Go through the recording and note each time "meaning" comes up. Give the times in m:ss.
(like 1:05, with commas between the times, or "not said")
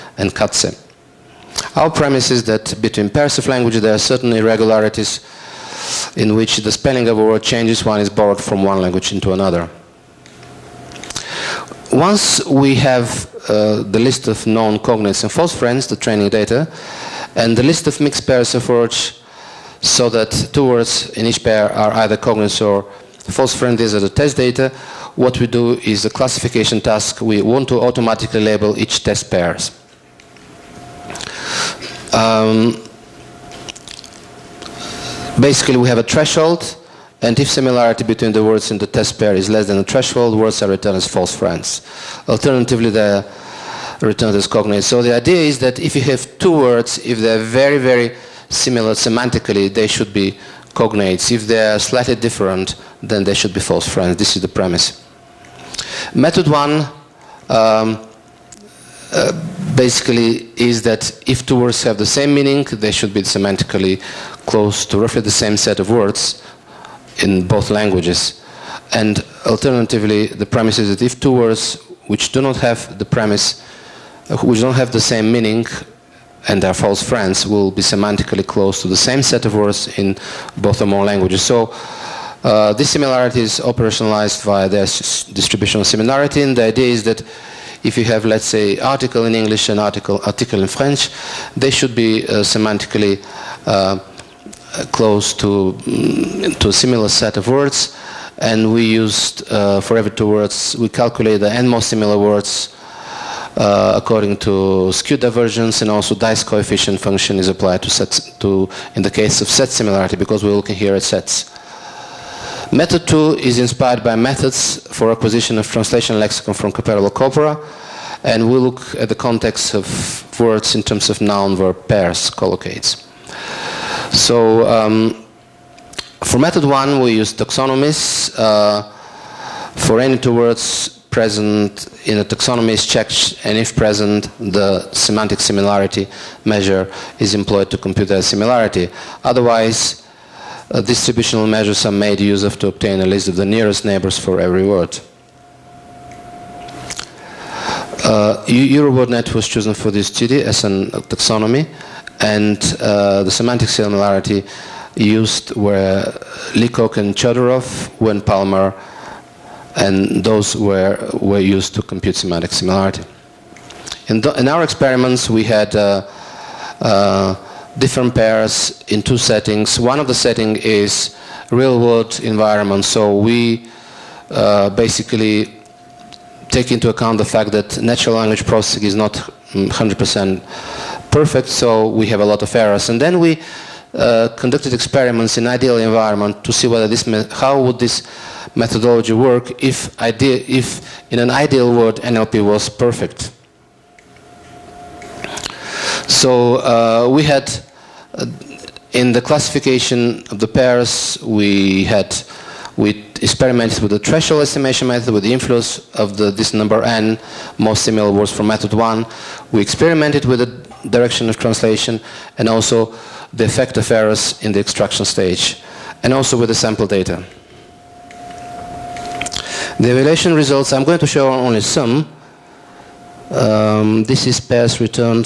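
1:02, 1:15.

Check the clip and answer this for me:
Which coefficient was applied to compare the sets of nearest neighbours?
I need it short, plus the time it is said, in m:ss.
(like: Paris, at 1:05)
Dice coefficient, at 1:46.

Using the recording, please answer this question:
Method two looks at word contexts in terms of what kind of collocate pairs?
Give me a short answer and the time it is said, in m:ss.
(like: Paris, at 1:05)
noun verb pairs, at 2:01.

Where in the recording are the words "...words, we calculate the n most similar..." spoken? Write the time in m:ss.
1:40.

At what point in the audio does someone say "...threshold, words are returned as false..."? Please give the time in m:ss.
0:39.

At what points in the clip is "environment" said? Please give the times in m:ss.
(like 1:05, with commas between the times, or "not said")
2:52, 3:05.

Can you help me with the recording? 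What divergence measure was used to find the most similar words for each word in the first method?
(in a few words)
skew divergence.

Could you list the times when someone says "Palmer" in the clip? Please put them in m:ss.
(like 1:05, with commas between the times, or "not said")
2:38.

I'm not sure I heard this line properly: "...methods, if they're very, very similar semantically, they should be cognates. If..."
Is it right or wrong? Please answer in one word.
wrong.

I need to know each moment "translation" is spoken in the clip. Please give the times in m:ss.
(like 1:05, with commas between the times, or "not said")
1:55, 3:31.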